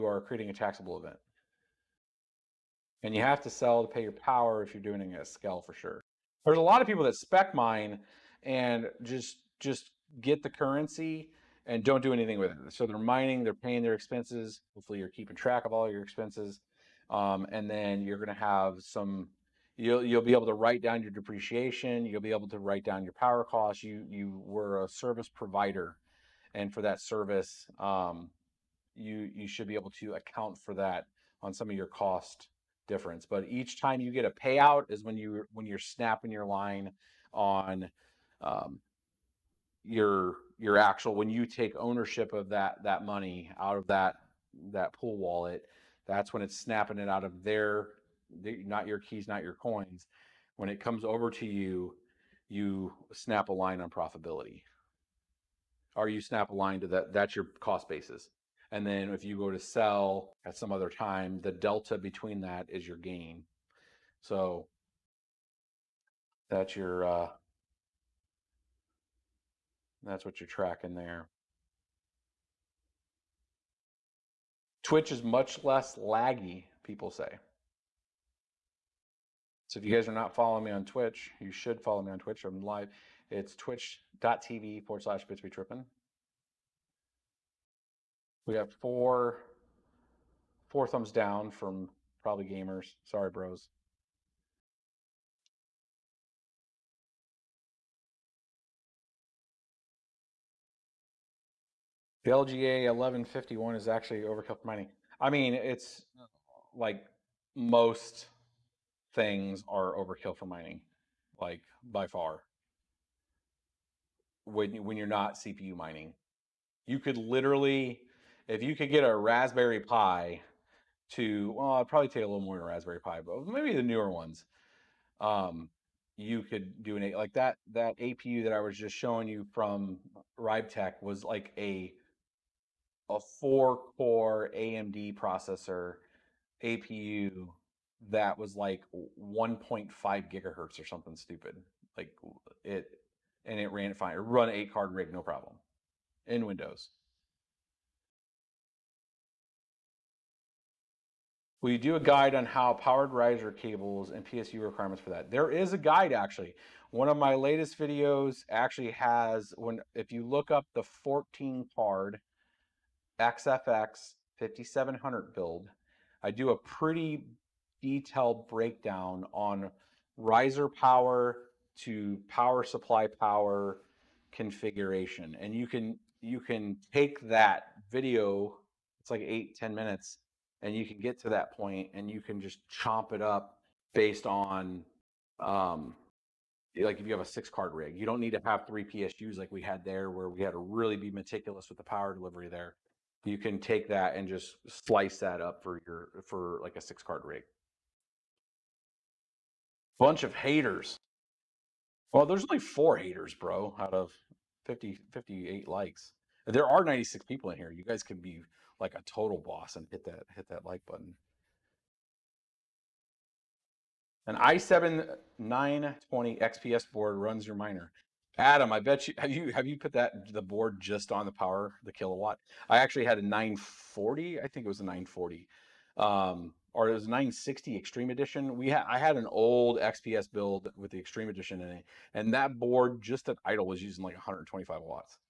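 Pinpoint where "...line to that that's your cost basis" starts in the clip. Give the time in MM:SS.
00:56.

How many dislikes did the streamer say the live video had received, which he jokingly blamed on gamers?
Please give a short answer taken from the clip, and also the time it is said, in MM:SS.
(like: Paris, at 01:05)
4, at 01:30.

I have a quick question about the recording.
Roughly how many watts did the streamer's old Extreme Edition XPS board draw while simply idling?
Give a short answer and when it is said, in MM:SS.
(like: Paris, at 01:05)
125, at 03:54.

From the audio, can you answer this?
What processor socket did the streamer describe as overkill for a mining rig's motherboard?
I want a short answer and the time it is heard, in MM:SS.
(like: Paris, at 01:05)
LGA 1151, at 01:42.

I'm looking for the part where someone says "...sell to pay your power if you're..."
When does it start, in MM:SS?
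00:03.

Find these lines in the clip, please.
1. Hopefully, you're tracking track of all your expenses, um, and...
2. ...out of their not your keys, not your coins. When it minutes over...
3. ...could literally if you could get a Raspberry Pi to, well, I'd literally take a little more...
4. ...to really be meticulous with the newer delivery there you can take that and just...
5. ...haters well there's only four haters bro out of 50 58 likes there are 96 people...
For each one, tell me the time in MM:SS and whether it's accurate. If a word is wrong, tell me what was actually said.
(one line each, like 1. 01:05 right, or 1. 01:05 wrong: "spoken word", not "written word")
1. 00:14 wrong: "keeping", not "tracking"
2. 00:47 wrong: "comes", not "minutes"
3. 01:56 wrong: "probably", not "literally"
4. 03:10 wrong: "power", not "newer"
5. 03:20 right.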